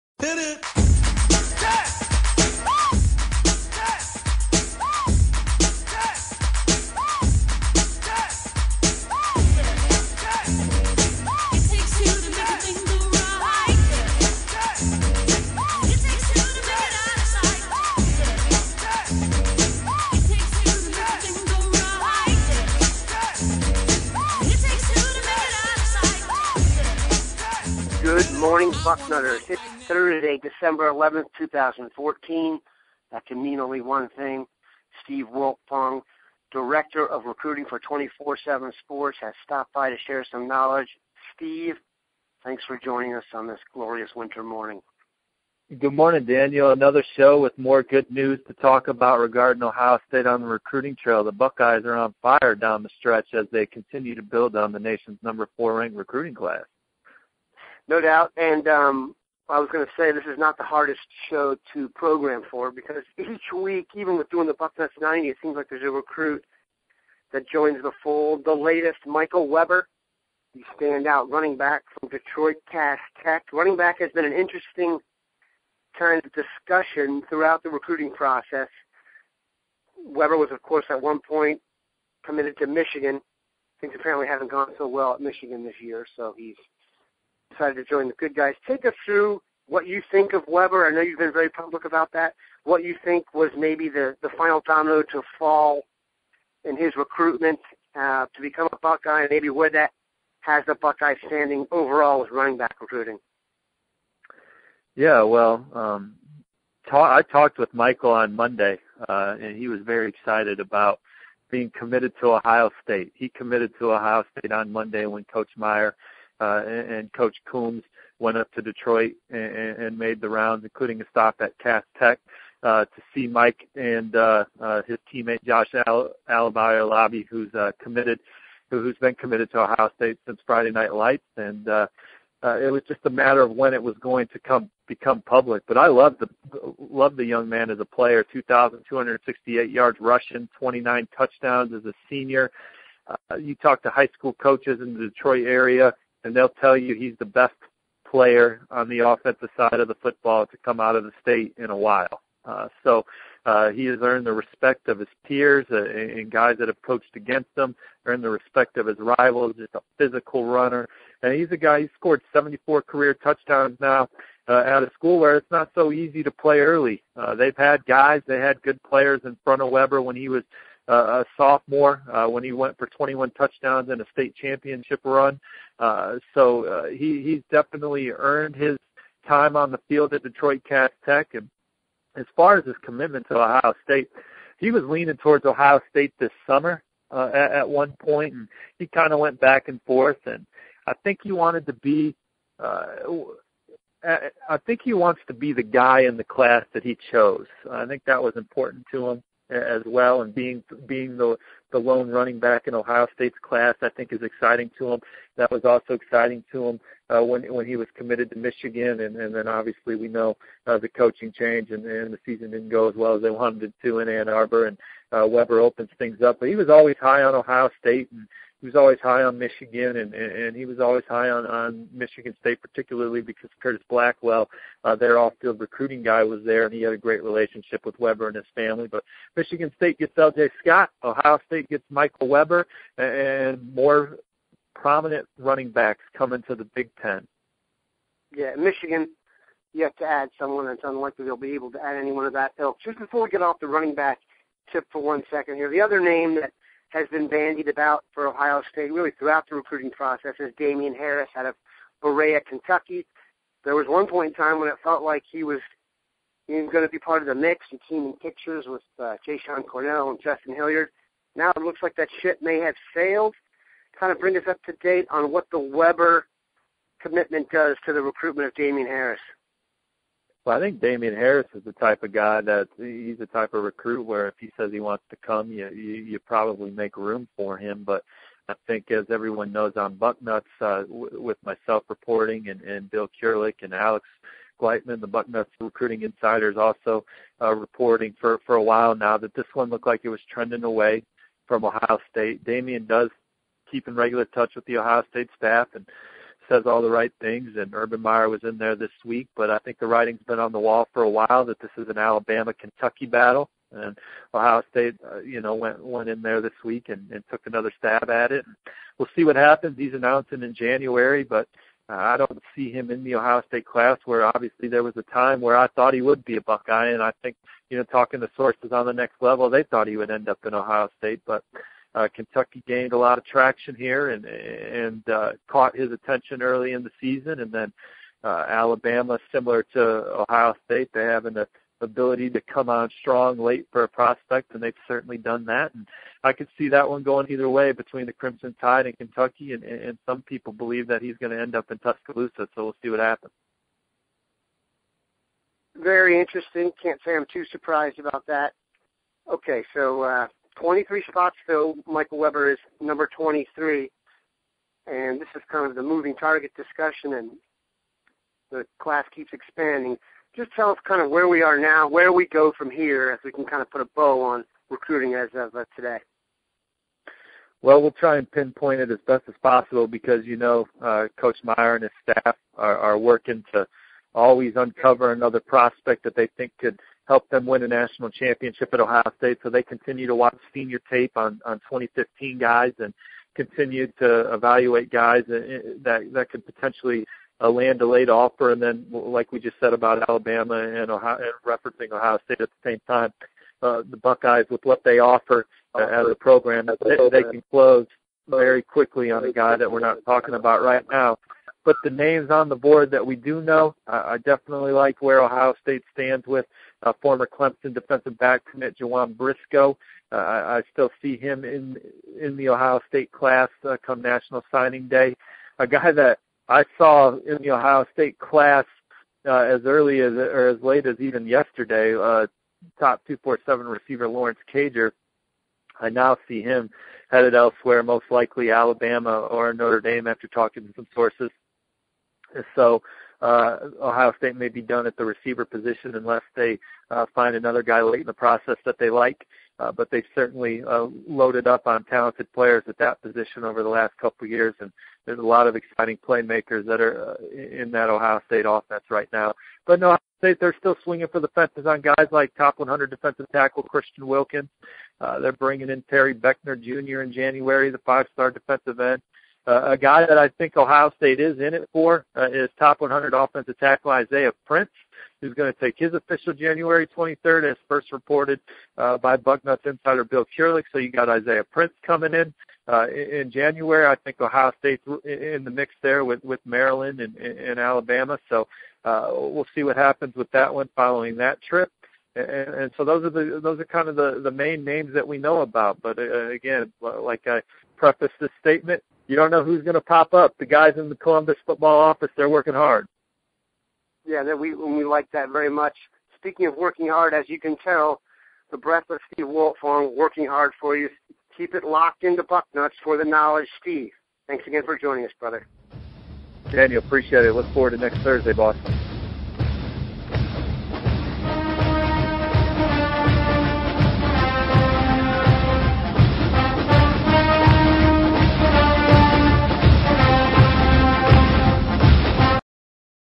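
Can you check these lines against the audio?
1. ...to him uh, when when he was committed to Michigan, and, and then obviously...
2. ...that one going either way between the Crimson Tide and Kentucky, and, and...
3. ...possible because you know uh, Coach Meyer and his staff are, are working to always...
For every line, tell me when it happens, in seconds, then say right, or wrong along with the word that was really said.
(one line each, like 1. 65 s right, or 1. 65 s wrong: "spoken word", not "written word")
1. 206 s right
2. 336 s right
3. 369 s right.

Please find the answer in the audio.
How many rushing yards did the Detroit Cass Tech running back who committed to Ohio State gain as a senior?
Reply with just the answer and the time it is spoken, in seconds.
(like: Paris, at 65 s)
2,268, at 138 s.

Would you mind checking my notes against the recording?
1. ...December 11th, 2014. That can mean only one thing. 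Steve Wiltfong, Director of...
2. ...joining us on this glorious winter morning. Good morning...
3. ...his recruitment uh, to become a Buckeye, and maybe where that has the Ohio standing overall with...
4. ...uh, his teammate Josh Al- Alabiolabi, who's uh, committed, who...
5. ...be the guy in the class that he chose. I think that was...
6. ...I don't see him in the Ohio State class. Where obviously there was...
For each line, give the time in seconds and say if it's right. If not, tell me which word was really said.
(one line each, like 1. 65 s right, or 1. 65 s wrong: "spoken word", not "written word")
1. 30 s right
2. 42 s right
3. 96 s wrong: "Buckeye", not "Ohio"
4. 124 s right
5. 195 s right
6. 311 s right.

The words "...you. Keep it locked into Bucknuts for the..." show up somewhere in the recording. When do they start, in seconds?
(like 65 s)
500 s.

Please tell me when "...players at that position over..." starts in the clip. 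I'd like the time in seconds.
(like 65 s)
442 s.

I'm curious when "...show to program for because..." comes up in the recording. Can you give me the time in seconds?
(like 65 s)
61 s.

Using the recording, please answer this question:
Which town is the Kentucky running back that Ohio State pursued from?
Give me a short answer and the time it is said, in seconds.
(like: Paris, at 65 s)
Berea, at 252 s.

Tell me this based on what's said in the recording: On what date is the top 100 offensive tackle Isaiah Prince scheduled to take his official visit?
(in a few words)
January 23rd.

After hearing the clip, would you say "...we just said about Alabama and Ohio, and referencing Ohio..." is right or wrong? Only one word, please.
right.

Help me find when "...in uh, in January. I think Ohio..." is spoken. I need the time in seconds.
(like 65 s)
472 s.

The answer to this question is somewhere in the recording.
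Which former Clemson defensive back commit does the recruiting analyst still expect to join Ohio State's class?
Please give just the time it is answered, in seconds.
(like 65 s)
408 s.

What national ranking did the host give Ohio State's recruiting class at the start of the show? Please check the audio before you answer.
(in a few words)
4.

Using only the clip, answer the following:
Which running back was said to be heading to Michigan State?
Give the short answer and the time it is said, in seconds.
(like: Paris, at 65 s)
L.J. Scott, at 230 s.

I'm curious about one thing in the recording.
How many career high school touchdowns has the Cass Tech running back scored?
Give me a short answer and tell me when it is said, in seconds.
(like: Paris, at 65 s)
74, at 162 s.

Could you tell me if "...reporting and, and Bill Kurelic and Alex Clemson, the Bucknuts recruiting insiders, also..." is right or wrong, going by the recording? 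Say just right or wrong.
wrong.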